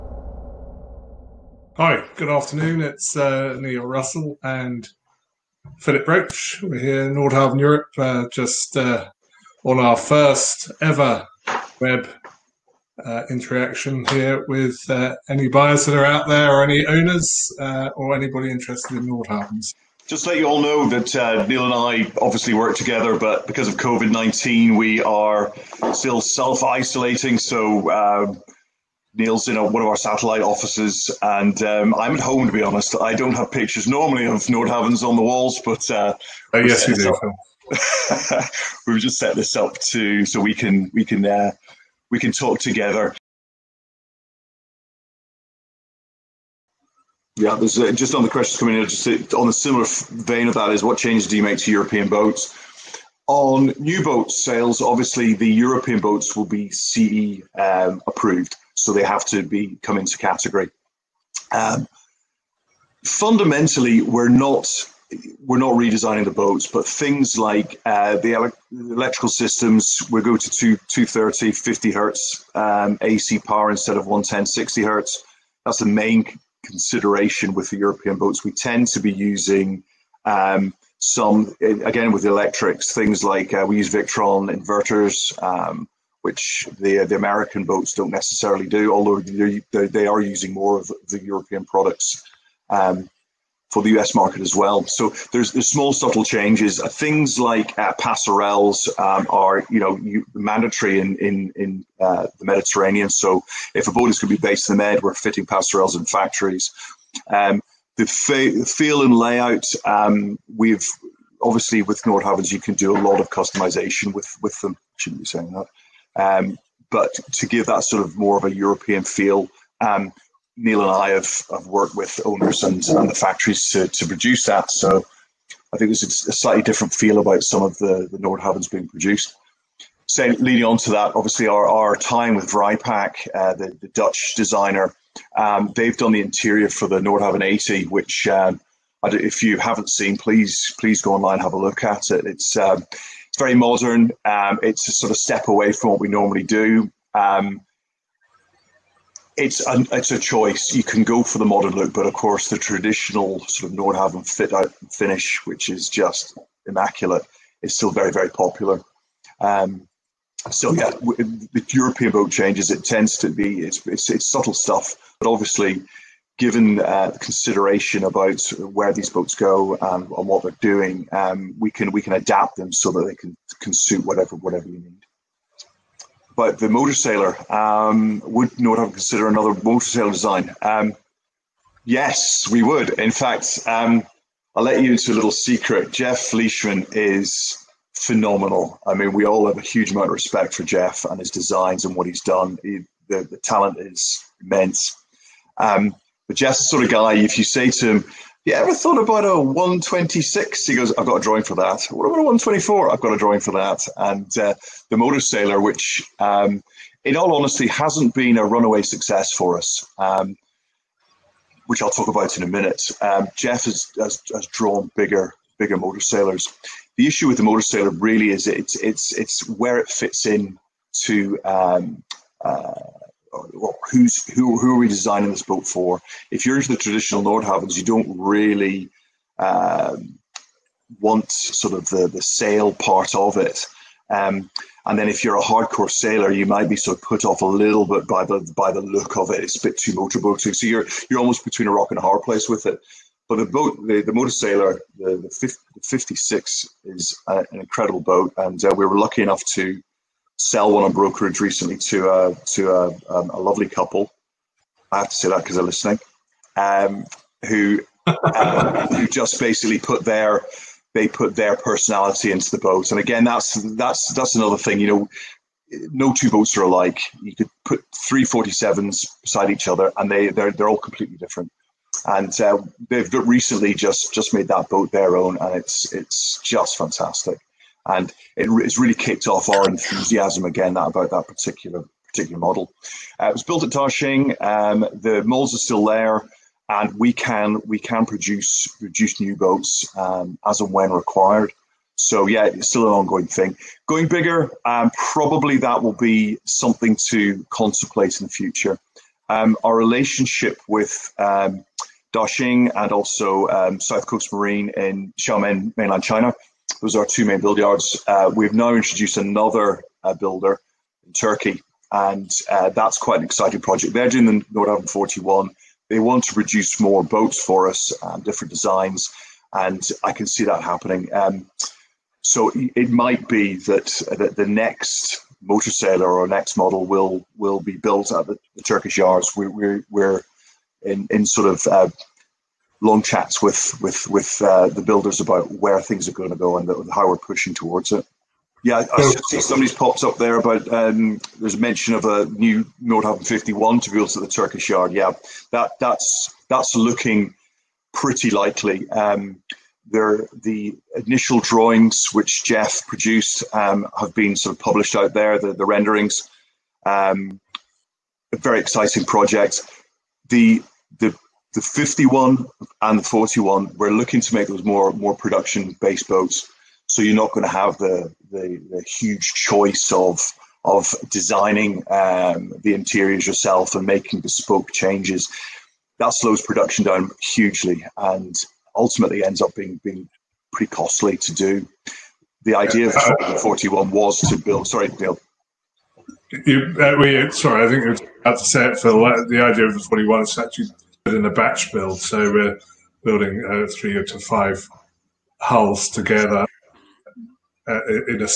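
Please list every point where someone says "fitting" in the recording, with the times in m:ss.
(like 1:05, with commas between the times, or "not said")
1:45.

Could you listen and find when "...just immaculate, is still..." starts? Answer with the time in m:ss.
2:35.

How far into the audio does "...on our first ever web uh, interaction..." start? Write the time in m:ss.
0:09.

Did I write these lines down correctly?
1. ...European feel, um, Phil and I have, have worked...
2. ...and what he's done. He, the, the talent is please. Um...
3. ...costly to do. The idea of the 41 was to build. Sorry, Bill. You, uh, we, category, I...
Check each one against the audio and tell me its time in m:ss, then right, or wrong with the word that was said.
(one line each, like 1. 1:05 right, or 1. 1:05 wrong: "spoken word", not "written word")
1. 1:58 wrong: "Neil", not "Phil"
2. 3:11 wrong: "immense", not "please"
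3. 6:20 wrong: "sorry", not "category".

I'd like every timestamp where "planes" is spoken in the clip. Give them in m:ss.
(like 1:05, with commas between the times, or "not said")
not said.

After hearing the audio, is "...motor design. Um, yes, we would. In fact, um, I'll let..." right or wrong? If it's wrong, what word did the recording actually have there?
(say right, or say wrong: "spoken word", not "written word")
wrong: "sailor", not "motor".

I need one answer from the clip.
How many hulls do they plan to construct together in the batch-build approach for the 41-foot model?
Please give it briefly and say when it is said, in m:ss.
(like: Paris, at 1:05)
3 to 5, at 6:33.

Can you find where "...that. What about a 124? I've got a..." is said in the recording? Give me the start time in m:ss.
3:21.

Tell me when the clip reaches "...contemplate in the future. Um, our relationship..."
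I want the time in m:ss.
4:57.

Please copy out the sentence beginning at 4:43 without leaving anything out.
Uh, it was built at Ta Shing.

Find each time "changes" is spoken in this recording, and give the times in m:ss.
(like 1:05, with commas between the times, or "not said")
0:50, 1:36, 2:42, 6:14.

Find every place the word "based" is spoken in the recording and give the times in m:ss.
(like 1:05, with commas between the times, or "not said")
1:44, 6:05.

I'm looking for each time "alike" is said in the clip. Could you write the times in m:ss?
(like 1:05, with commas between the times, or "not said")
4:26.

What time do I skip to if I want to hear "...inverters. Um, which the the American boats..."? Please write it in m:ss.
1:24.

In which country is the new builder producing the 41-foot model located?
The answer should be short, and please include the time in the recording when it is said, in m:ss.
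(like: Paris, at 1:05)
Turkey, at 5:11.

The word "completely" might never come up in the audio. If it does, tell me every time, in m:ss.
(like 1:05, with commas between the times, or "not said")
4:30.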